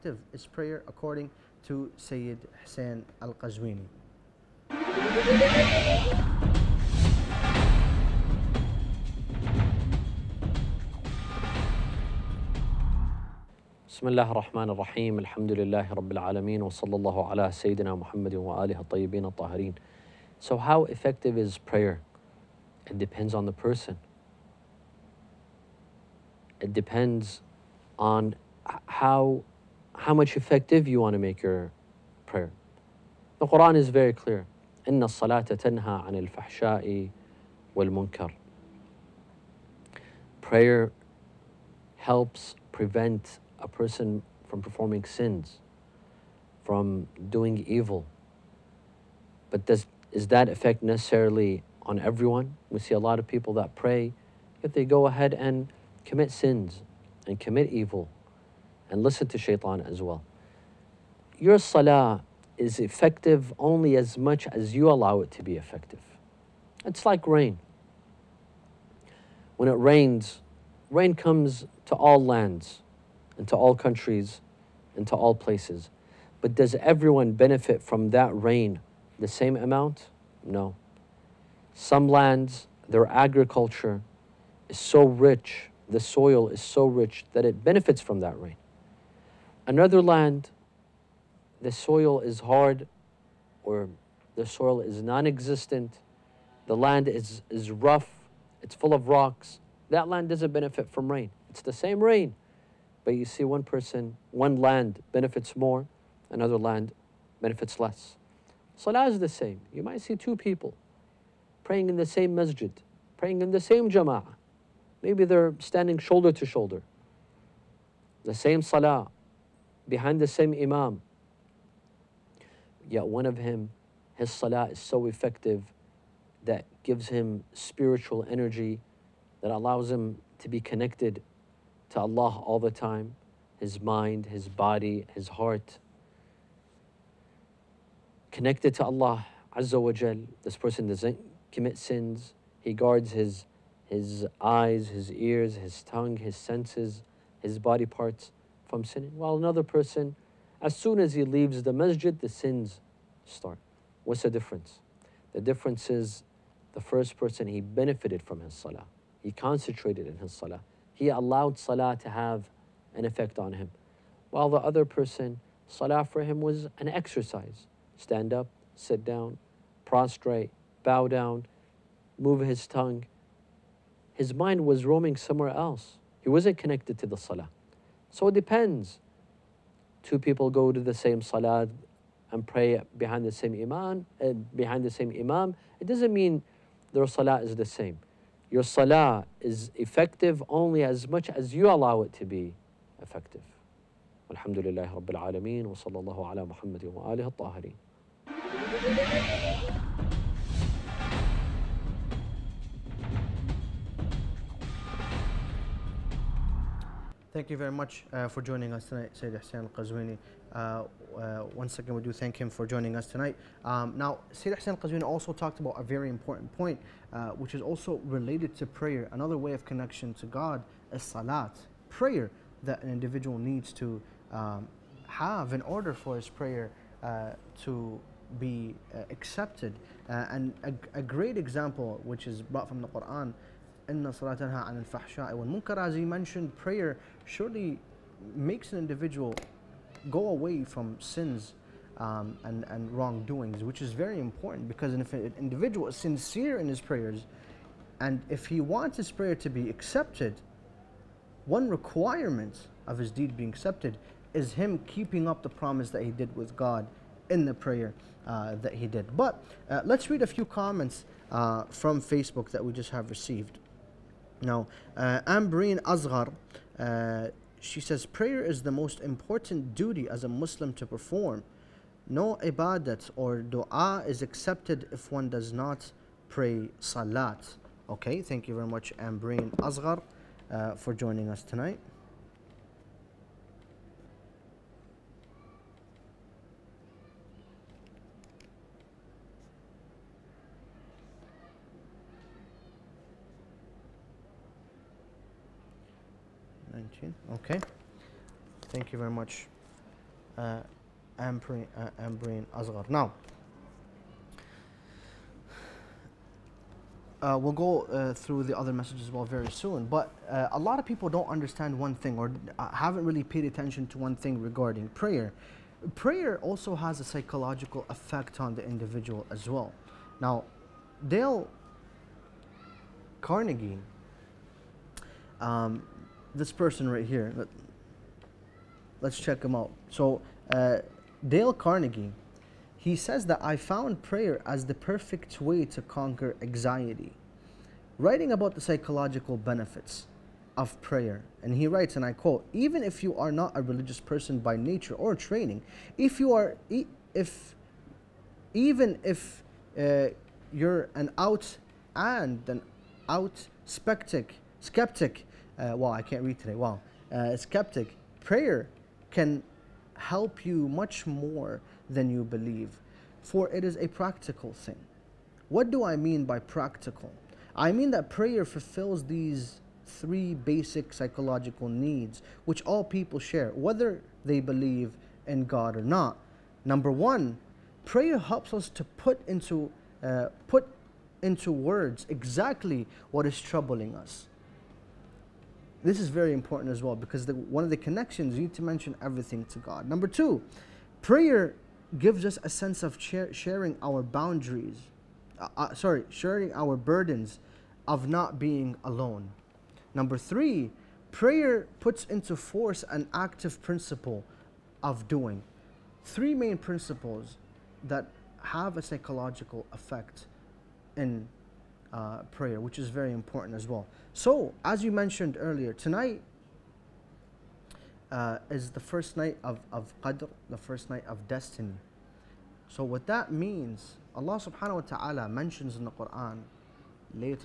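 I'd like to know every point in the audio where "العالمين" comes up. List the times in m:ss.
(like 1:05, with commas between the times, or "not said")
0:16, 3:15.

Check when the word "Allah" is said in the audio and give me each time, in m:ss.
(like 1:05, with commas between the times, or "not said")
2:11, 2:18, 7:04.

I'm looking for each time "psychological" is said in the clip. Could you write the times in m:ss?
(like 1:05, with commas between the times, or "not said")
5:17, 5:38, 6:10, 6:48.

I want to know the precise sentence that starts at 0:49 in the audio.
But does, is that effect necessarily on everyone?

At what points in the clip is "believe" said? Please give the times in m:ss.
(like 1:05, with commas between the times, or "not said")
6:02, 6:14.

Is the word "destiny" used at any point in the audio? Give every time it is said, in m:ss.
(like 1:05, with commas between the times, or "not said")
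7:01.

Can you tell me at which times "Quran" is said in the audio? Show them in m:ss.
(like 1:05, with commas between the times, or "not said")
0:33, 3:52, 7:05.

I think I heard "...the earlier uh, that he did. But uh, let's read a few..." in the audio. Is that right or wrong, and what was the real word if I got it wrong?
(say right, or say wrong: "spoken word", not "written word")
wrong: "prayer", not "earlier".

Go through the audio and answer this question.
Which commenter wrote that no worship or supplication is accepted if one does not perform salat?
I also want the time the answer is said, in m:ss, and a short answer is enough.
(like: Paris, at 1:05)
Ambreen Asghar, at 4:25.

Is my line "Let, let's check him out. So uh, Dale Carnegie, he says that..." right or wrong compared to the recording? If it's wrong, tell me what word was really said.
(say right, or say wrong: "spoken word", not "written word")
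right.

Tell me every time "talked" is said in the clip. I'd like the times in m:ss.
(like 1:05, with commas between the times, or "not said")
3:35.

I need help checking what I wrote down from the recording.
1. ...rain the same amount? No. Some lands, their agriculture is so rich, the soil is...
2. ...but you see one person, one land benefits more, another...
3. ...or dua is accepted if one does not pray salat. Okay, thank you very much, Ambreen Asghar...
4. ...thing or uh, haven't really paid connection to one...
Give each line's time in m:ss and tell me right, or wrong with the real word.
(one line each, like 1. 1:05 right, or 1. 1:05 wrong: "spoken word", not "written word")
1. 1:18 right
2. 1:43 right
3. 4:33 right
4. 5:11 wrong: "attention", not "connection".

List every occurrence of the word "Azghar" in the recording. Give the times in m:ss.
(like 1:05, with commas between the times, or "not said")
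4:25.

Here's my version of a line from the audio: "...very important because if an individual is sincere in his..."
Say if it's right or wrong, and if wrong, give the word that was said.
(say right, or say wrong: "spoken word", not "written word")
right.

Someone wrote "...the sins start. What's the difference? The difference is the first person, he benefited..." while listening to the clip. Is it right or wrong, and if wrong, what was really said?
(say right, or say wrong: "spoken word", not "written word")
right.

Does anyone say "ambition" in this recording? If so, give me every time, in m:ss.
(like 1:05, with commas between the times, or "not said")
not said.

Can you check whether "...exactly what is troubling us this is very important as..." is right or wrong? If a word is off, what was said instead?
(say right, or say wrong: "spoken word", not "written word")
right.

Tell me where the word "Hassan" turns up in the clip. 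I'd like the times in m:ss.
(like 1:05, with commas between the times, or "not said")
3:29, 3:34.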